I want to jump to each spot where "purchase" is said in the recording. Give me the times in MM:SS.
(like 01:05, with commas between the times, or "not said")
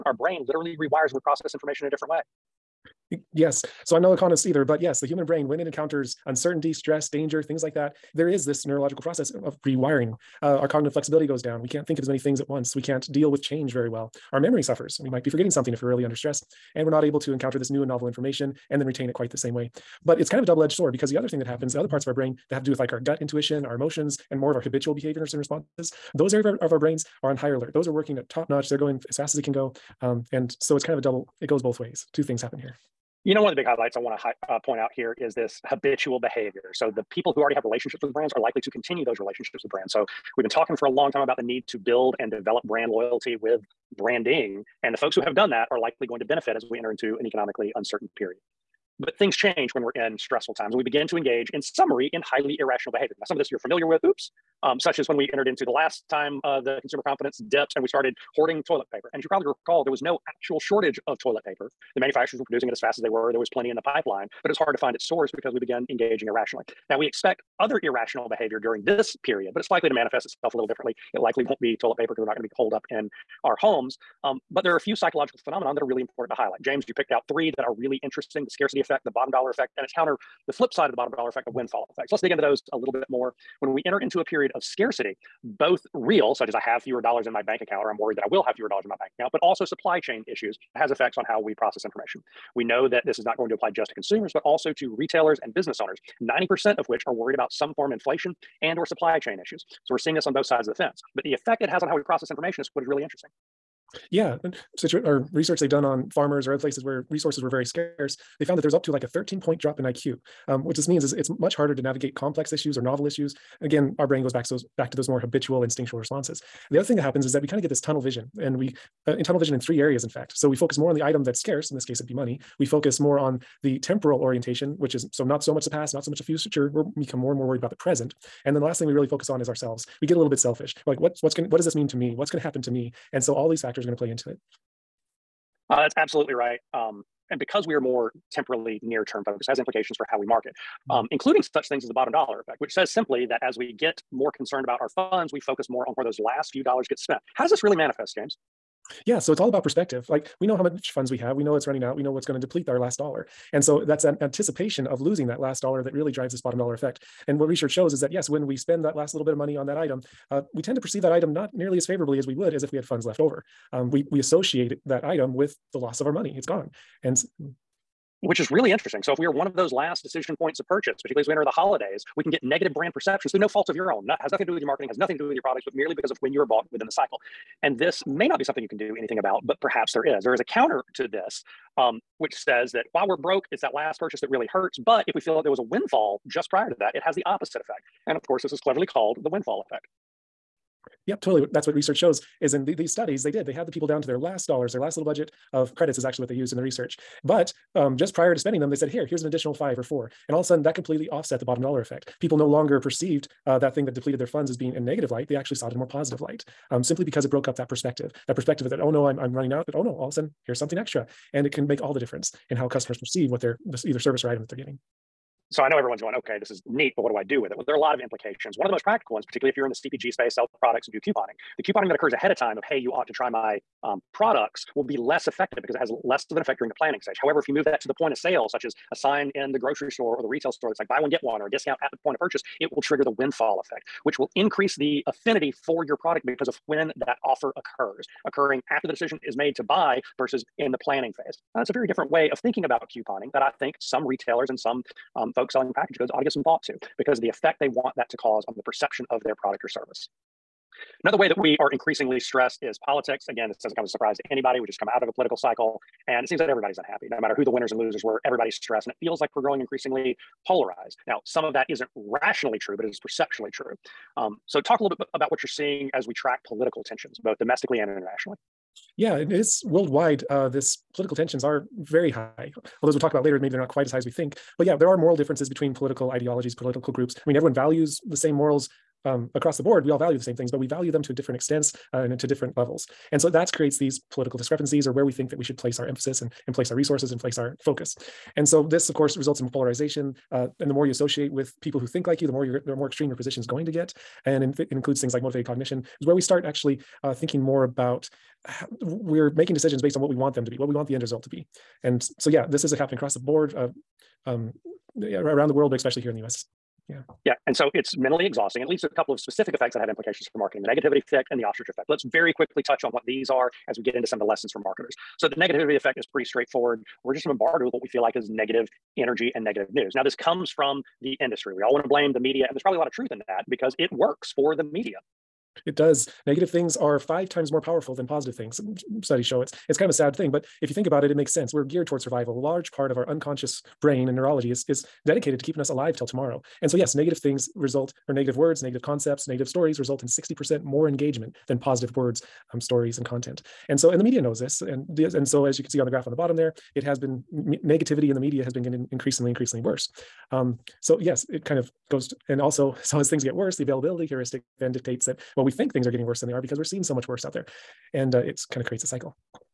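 02:50, 03:03, 03:52.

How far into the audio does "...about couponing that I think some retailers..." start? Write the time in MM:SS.
04:02.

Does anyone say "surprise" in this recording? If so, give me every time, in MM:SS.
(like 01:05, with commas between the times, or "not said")
04:13.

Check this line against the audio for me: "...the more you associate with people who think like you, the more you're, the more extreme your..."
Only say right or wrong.
right.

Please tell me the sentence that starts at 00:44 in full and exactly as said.
And the folks who have done that are likely going to benefit as we enter into an economically uncertain period.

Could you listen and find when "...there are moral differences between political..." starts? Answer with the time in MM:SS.
04:34.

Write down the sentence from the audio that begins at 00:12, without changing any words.
We can't deal with change very well.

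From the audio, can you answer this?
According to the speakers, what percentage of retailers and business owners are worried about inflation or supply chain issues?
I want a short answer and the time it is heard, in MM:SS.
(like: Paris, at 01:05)
90%, at 01:36.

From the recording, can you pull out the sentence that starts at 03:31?
And it can make all the difference in how customers perceive what they're, this either service or item that they're getting.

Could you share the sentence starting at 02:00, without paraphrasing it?
So we focus more on the item that's scarce, in this case, it'd be money.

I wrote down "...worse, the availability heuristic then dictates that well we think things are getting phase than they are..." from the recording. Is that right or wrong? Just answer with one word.
wrong.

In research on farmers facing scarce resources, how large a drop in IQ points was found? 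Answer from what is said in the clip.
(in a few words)
13 points.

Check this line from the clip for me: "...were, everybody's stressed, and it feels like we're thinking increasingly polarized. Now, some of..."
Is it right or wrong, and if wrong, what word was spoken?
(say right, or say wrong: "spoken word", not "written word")
wrong: "growing", not "thinking".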